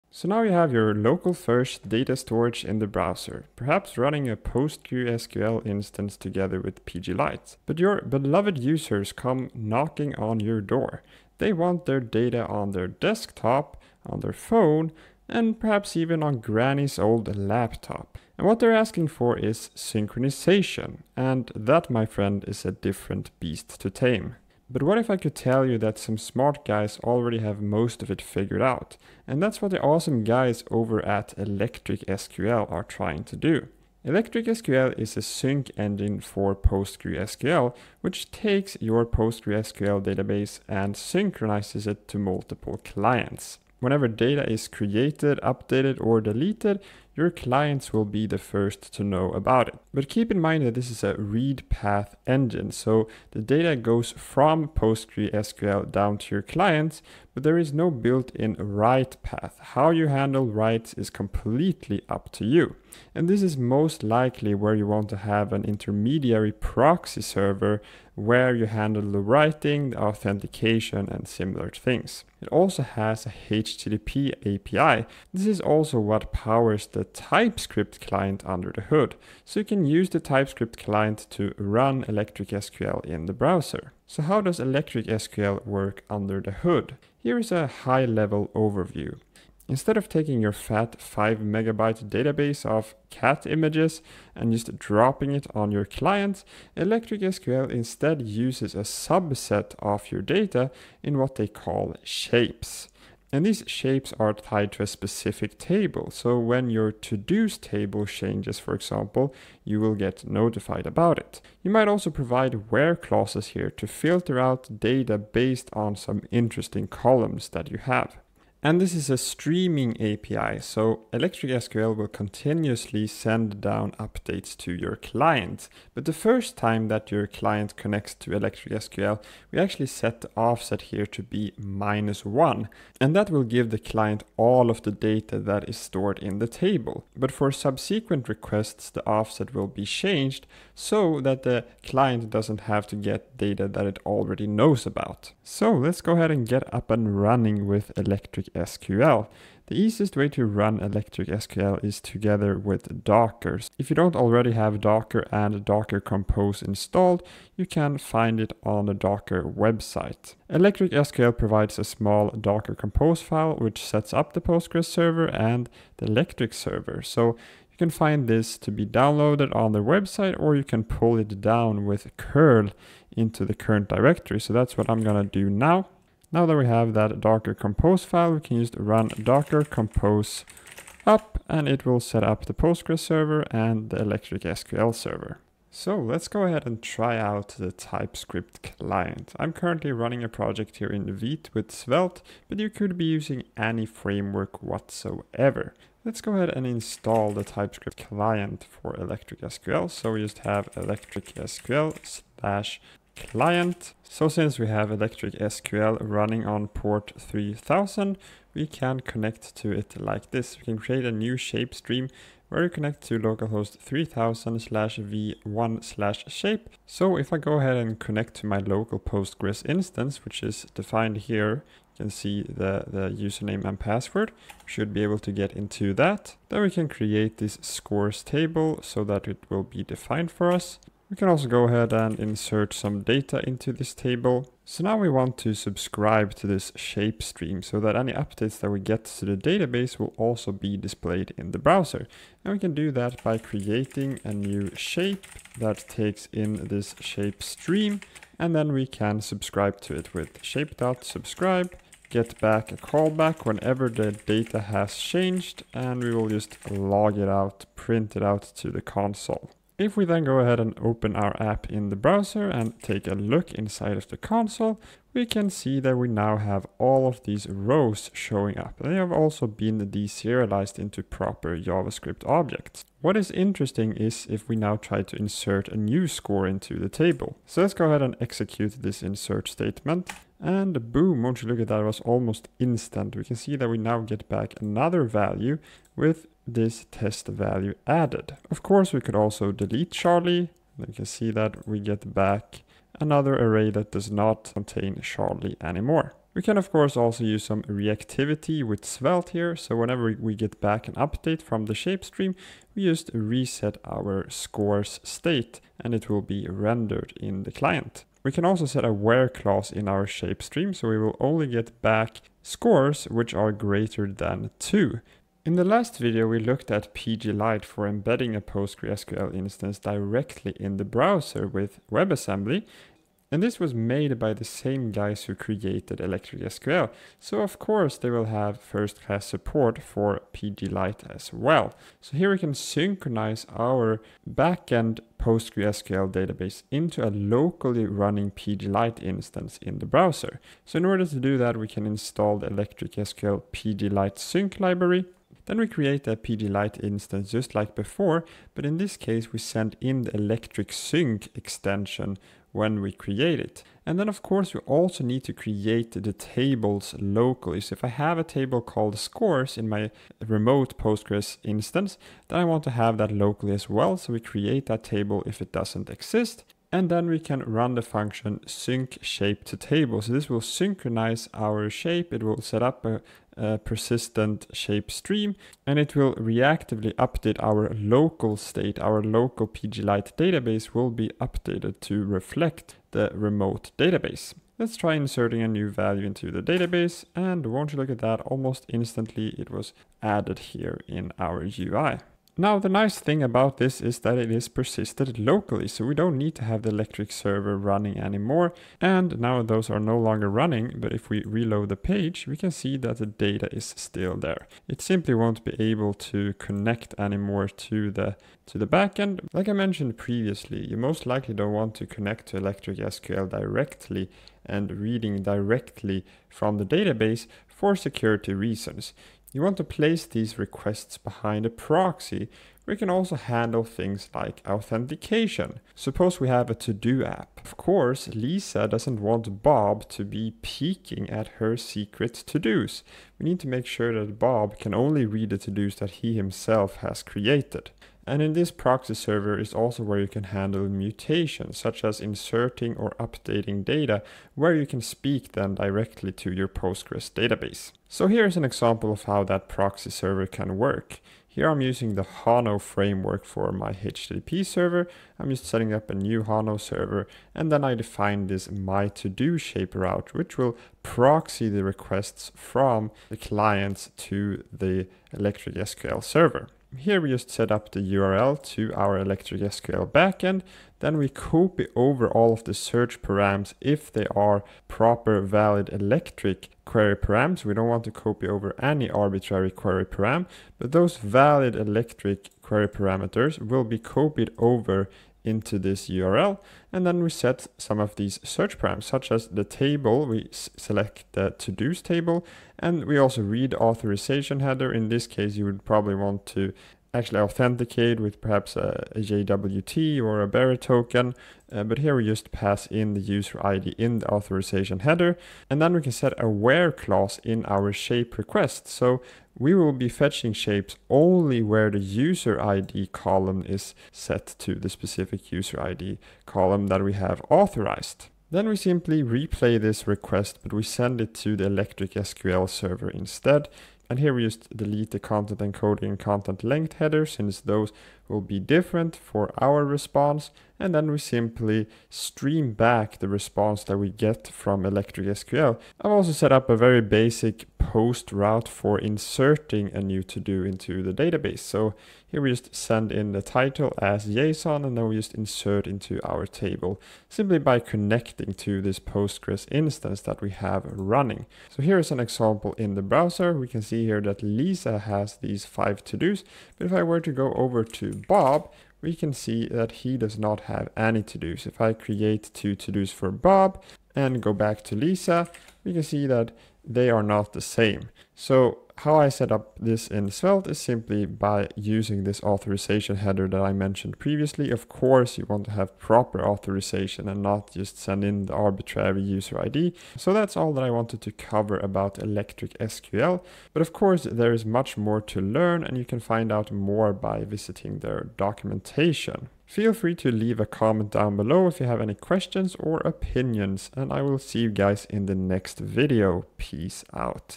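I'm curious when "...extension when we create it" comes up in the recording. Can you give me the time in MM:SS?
05:51.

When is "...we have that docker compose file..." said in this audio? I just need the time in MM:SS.
02:56.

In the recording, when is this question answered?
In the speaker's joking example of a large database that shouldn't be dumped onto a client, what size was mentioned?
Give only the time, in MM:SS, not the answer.
01:31.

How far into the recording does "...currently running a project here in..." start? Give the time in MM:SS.
03:09.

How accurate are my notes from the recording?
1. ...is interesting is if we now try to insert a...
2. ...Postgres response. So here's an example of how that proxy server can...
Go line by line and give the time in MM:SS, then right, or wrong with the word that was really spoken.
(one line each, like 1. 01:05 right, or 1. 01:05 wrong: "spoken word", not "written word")
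1. 04:33 right
2. 07:26 wrong: "database", not "response".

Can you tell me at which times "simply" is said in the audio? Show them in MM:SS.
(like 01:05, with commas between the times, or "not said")
06:44, 08:38, 08:50, 09:07, 09:30.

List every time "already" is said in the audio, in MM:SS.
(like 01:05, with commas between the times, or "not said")
00:27, 02:24, 02:34.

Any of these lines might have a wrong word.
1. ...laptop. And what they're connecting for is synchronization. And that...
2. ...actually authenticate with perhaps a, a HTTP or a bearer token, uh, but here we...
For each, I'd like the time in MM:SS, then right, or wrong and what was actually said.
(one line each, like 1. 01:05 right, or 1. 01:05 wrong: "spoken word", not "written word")
1. 00:17 wrong: "asking", not "connecting"
2. 08:16 wrong: "JWT", not "HTTP".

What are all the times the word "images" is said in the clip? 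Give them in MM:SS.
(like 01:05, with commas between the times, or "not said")
01:33.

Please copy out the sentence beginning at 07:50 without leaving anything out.
Then we copy over all of the search params if they are proper valid Electric query params.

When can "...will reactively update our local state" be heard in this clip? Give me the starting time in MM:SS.
06:15.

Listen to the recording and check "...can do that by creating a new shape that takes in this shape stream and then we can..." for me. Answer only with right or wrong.
right.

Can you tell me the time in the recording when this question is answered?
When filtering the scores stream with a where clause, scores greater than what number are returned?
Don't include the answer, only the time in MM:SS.
05:14.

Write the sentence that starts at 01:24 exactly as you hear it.
So how does Electric SQL work under the hood?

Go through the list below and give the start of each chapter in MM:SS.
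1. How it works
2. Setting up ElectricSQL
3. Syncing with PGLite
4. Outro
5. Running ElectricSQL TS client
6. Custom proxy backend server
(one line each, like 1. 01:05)
1. 01:24
2. 02:25
3. 05:16
4. 09:40
5. 03:06
6. 06:50.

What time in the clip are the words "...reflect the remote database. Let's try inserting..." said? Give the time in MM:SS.
06:22.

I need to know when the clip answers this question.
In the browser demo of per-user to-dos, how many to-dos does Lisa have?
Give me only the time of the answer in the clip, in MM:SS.
09:15.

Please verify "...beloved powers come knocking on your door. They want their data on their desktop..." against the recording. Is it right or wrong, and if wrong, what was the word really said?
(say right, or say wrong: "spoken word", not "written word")
wrong: "users", not "powers".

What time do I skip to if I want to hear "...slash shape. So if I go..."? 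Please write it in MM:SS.
03:35.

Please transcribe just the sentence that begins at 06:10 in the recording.
So this will synchronize our shape.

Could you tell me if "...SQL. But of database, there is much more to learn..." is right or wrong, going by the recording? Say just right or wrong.
wrong.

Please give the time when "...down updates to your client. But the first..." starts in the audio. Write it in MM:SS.
02:03.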